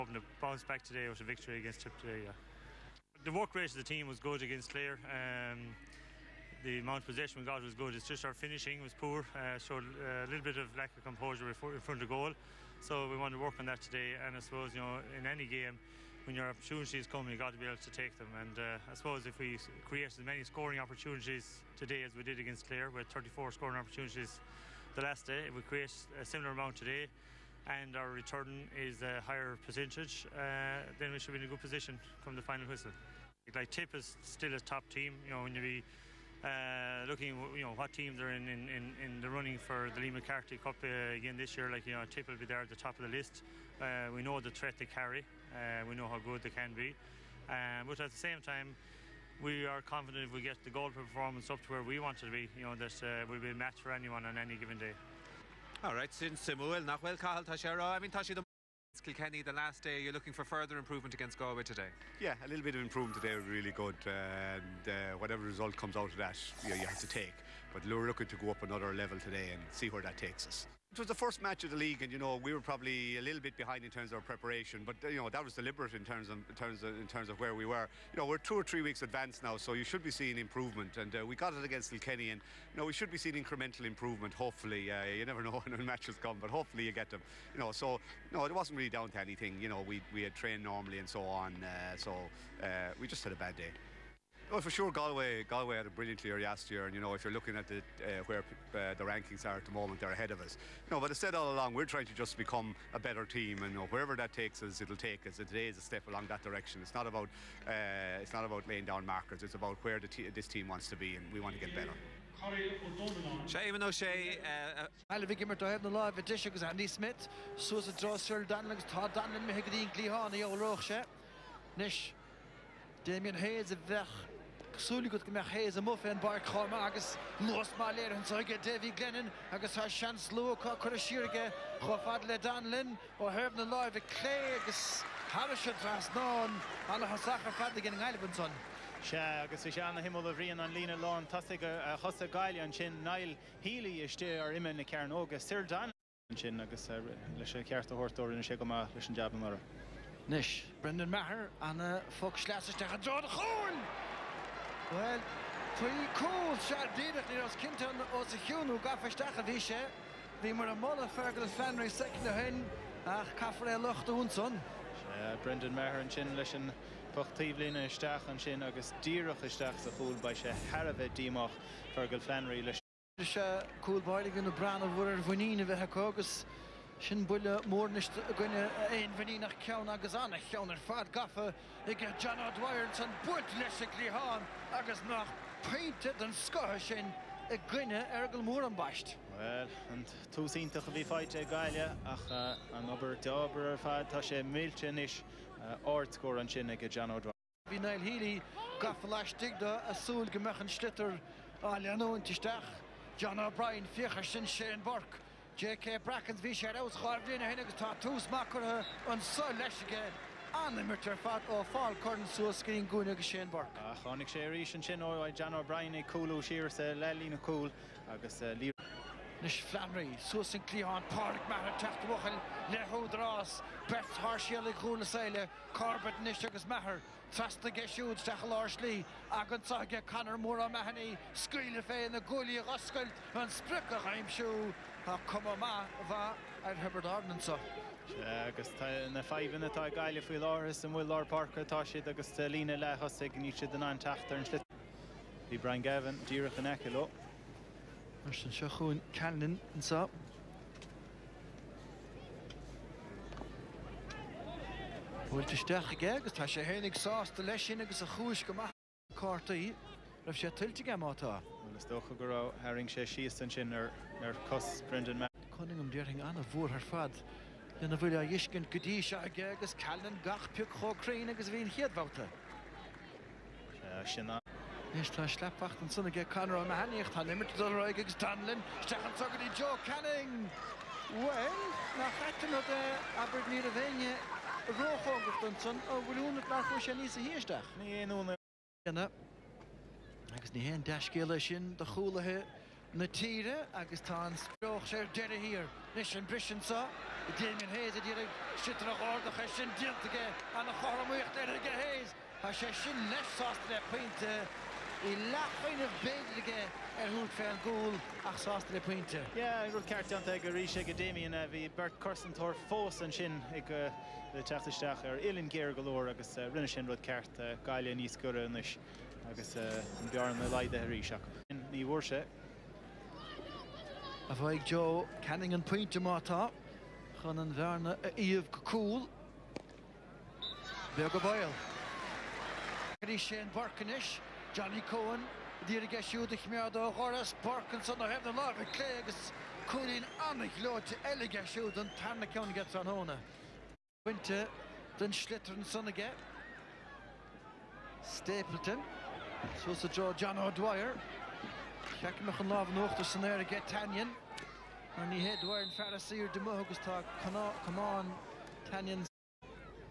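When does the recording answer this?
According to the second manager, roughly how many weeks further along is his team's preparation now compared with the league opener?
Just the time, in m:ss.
1:18.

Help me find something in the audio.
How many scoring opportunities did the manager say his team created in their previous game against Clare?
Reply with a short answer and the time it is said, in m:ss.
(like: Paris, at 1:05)
34, at 0:23.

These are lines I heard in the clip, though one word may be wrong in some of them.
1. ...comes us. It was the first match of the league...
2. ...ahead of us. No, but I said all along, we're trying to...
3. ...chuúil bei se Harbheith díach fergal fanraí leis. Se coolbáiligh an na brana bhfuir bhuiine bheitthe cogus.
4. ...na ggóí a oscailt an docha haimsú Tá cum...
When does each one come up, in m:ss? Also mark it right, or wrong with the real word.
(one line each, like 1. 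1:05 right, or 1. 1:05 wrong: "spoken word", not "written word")
1. 1:10 wrong: "takes", not "comes"
2. 1:40 right
3. 2:49 right
4. 3:52 wrong: "sppriccha", not "docha".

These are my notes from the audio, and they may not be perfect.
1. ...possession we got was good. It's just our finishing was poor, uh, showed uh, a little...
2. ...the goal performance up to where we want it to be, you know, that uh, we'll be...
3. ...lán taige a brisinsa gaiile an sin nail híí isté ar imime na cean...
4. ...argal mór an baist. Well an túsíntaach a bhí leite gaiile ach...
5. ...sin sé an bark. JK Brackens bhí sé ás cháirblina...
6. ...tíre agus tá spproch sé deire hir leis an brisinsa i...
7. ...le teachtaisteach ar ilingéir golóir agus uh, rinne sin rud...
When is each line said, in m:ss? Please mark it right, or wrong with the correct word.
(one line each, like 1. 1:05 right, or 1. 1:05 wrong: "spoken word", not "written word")
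1. 0:07 right
2. 0:50 right
3. 2:20 wrong: "chosa", not "brisinsa"
4. 3:08 wrong: "feite", not "leite"
5. 3:24 right
6. 4:53 right
7. 5:14 right.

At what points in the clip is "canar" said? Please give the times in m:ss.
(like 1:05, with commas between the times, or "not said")
3:50, 4:36.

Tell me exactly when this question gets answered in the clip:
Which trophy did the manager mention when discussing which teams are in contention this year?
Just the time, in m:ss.
0:40.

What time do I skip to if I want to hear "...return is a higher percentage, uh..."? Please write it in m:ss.
0:28.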